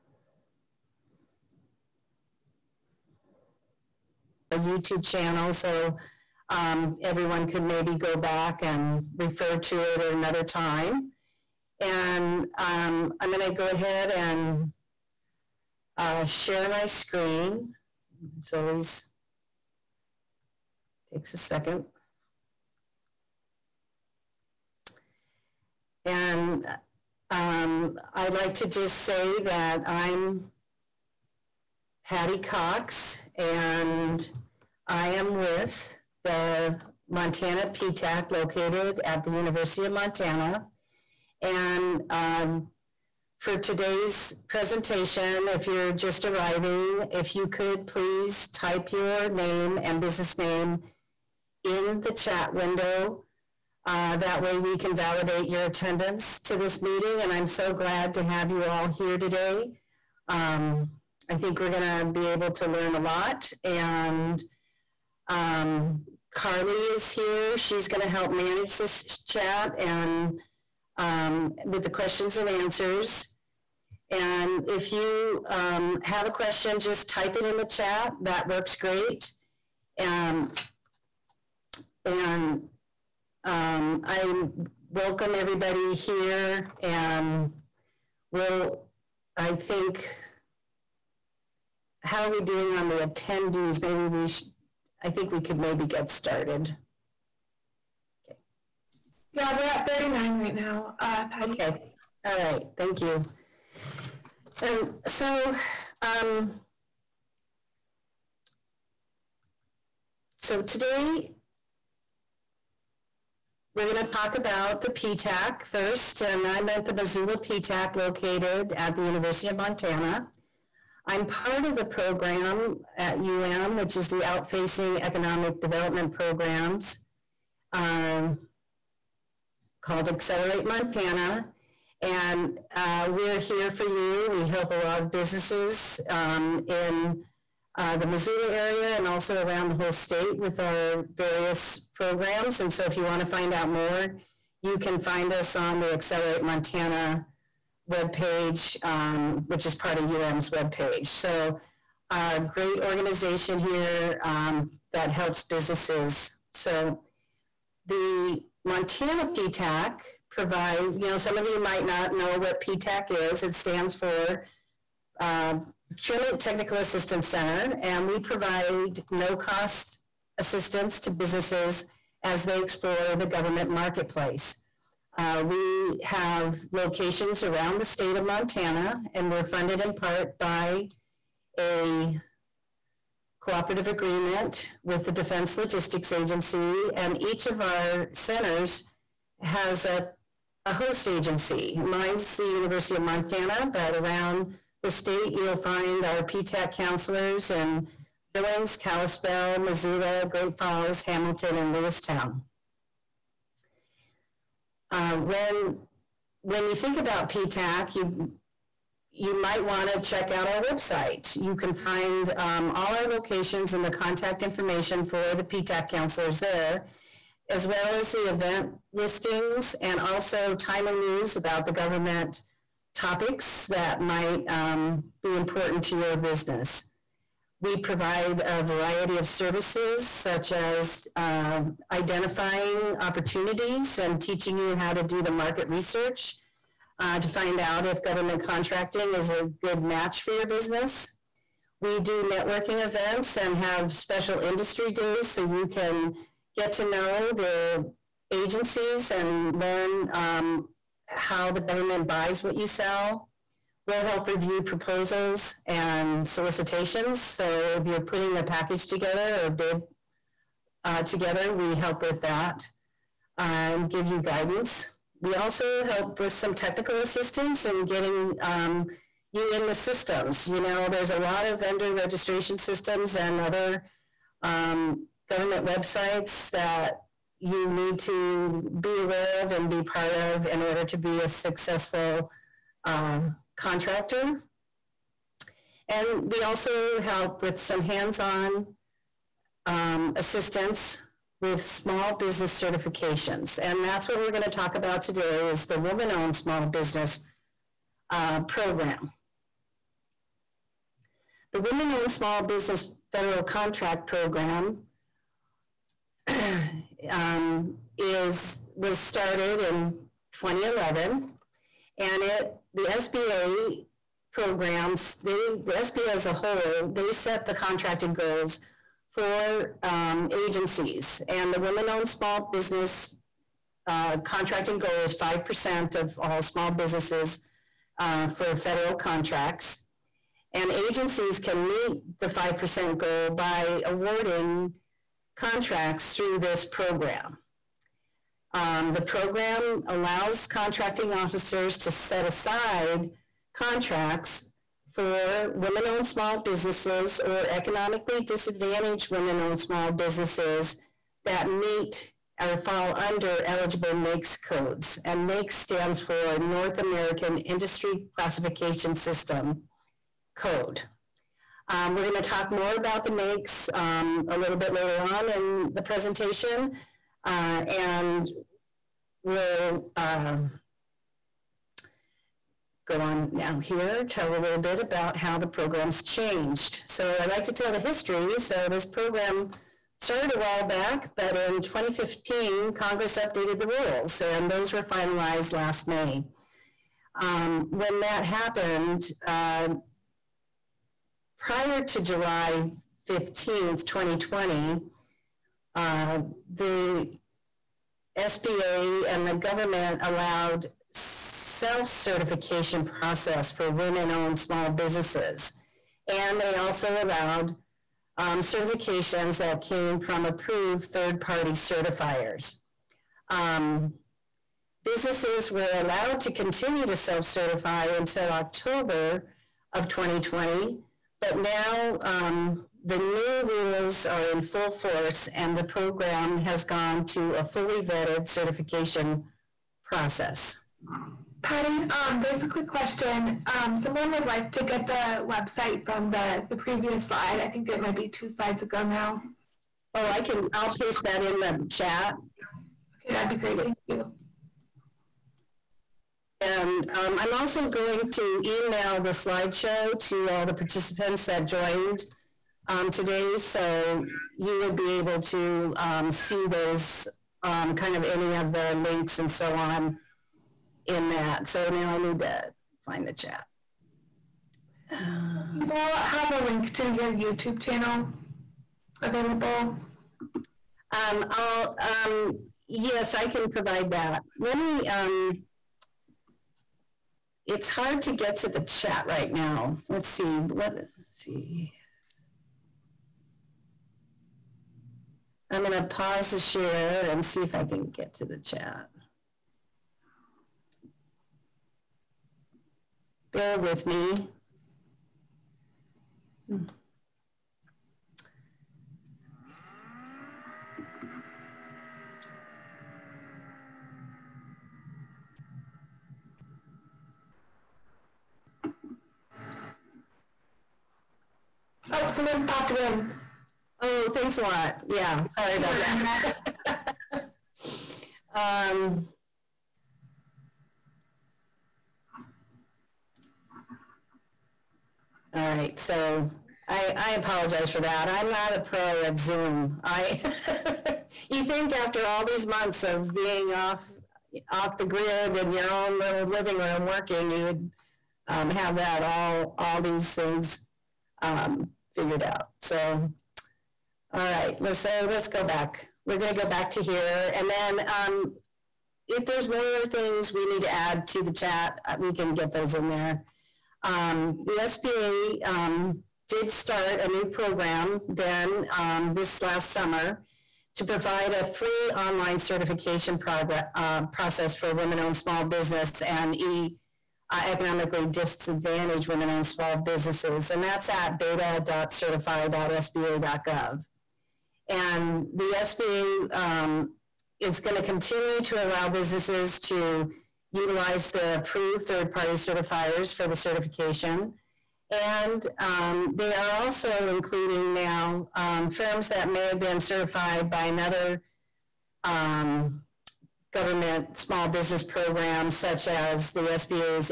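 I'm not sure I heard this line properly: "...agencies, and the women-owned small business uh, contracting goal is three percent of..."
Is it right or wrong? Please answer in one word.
wrong.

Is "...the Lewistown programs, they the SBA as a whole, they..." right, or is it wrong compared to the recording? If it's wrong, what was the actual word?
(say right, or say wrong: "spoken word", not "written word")
wrong: "SBA", not "Lewistown".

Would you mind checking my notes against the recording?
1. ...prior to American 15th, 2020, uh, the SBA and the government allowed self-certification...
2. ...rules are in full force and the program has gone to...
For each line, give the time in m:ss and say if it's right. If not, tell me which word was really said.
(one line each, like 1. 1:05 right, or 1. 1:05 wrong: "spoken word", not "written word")
1. 6:31 wrong: "July", not "American"
2. 7:03 right.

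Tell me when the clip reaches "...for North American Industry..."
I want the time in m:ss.
5:55.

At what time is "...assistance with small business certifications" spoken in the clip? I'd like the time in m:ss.
4:50.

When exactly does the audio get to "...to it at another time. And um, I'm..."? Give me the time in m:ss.
0:09.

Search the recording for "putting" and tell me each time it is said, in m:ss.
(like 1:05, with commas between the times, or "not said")
4:18.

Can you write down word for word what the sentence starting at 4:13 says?
We'll help review proposals and solicitations.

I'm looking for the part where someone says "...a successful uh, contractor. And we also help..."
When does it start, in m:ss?
4:41.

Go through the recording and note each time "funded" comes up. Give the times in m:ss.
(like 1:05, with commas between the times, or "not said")
2:59.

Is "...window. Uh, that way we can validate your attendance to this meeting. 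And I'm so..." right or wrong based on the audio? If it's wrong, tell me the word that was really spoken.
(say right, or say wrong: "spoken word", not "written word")
right.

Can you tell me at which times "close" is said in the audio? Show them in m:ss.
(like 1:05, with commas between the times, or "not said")
not said.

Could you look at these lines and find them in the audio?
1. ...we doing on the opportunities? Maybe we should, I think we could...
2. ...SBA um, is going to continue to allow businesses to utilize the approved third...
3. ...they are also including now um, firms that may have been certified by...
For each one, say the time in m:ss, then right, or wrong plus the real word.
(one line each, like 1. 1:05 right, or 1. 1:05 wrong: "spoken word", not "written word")
1. 1:32 wrong: "attendees", not "opportunities"
2. 9:35 right
3. 9:46 right.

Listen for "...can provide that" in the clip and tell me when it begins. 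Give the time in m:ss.
7:53.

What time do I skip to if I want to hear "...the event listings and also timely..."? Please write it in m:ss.
3:38.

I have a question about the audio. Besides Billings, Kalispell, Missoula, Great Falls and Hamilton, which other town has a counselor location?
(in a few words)
Lewistown.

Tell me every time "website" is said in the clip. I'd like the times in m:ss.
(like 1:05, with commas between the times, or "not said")
3:30, 4:35, 7:15.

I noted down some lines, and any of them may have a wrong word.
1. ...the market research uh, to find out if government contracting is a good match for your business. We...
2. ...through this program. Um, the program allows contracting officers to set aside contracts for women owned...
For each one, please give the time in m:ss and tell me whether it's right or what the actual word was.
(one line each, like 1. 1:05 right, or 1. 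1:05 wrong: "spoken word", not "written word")
1. 3:55 right
2. 5:36 right.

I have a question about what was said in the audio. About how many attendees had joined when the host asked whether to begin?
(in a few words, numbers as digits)
39.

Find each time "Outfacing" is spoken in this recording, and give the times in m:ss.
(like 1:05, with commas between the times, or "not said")
2:04.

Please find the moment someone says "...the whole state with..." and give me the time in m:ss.
2:19.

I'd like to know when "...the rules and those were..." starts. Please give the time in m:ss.
6:23.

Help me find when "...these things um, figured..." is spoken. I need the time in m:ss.
8:59.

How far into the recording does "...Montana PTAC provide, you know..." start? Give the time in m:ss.
2:38.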